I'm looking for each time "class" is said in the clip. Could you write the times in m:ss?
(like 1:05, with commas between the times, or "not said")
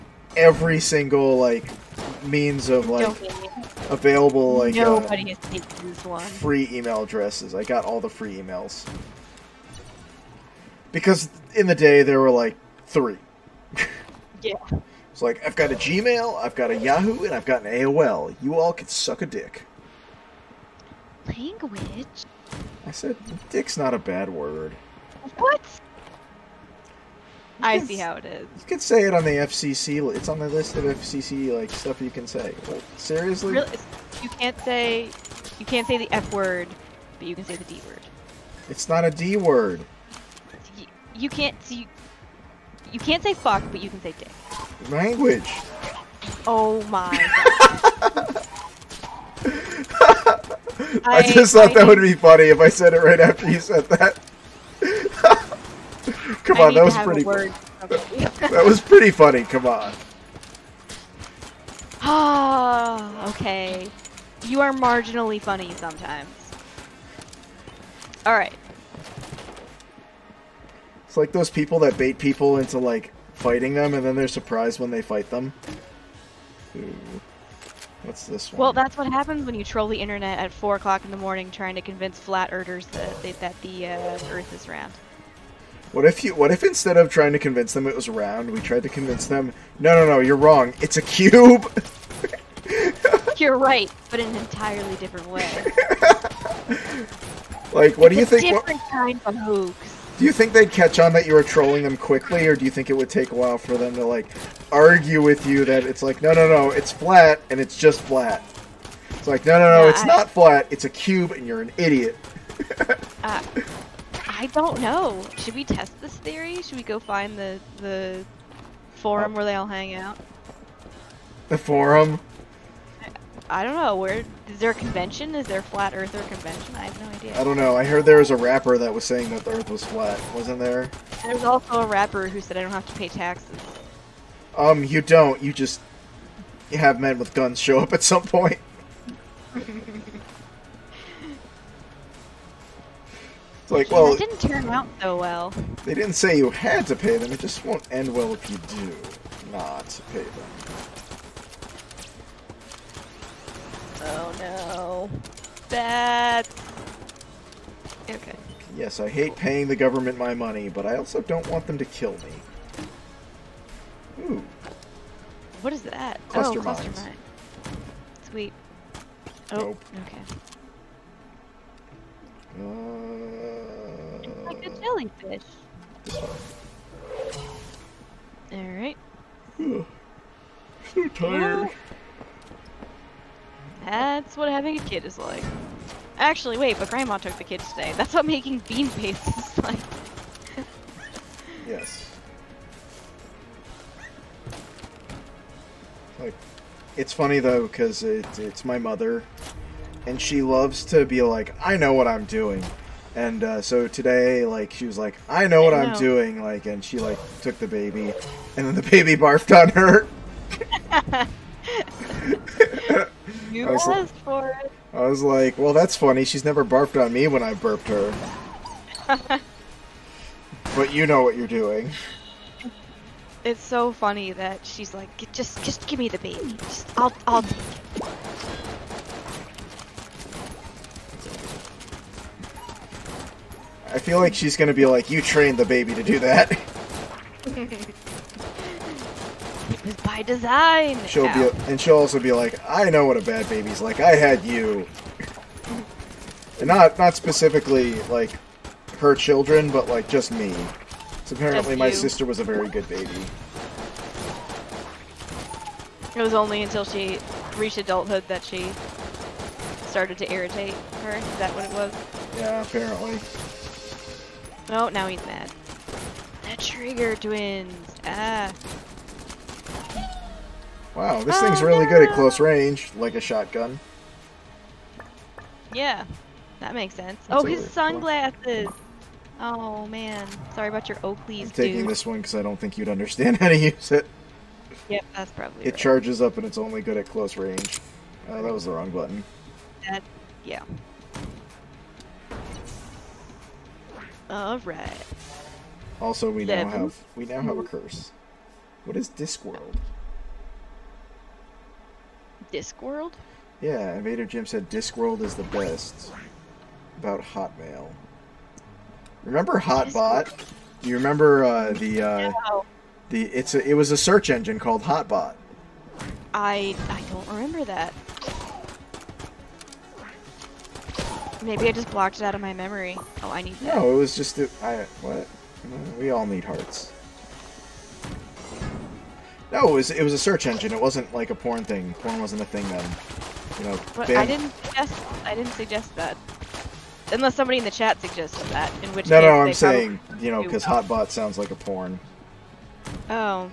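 not said.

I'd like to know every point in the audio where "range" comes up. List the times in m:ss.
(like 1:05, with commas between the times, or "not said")
4:32, 4:47.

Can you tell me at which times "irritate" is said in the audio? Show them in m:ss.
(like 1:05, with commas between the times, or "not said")
4:20.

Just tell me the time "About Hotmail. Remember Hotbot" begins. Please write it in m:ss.
5:06.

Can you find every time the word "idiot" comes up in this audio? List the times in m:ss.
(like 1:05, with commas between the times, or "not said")
1:51.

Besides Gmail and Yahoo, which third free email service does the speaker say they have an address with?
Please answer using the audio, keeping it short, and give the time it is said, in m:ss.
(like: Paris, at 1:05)
AOL, at 0:17.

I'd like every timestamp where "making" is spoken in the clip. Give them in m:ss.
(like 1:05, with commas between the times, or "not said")
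3:08.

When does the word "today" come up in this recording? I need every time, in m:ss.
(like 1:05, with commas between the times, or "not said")
3:07, 3:23.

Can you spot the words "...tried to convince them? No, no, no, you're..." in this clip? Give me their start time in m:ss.
1:28.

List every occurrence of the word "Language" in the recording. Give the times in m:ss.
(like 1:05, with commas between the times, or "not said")
0:21, 0:44.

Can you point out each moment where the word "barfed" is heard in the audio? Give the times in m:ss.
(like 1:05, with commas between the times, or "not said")
3:29, 3:36.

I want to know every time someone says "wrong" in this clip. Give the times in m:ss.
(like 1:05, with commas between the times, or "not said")
1:30, 4:48.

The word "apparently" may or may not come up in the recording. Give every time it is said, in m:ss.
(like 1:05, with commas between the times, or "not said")
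4:11, 4:22.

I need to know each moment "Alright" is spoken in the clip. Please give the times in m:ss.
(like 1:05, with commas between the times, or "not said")
2:58, 4:54.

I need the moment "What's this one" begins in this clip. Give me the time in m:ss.
1:18.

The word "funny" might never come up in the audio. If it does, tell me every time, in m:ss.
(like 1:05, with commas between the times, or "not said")
0:52, 0:59, 1:05, 3:17, 3:35, 3:43.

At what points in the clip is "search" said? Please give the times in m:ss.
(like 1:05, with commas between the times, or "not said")
5:13, 5:30.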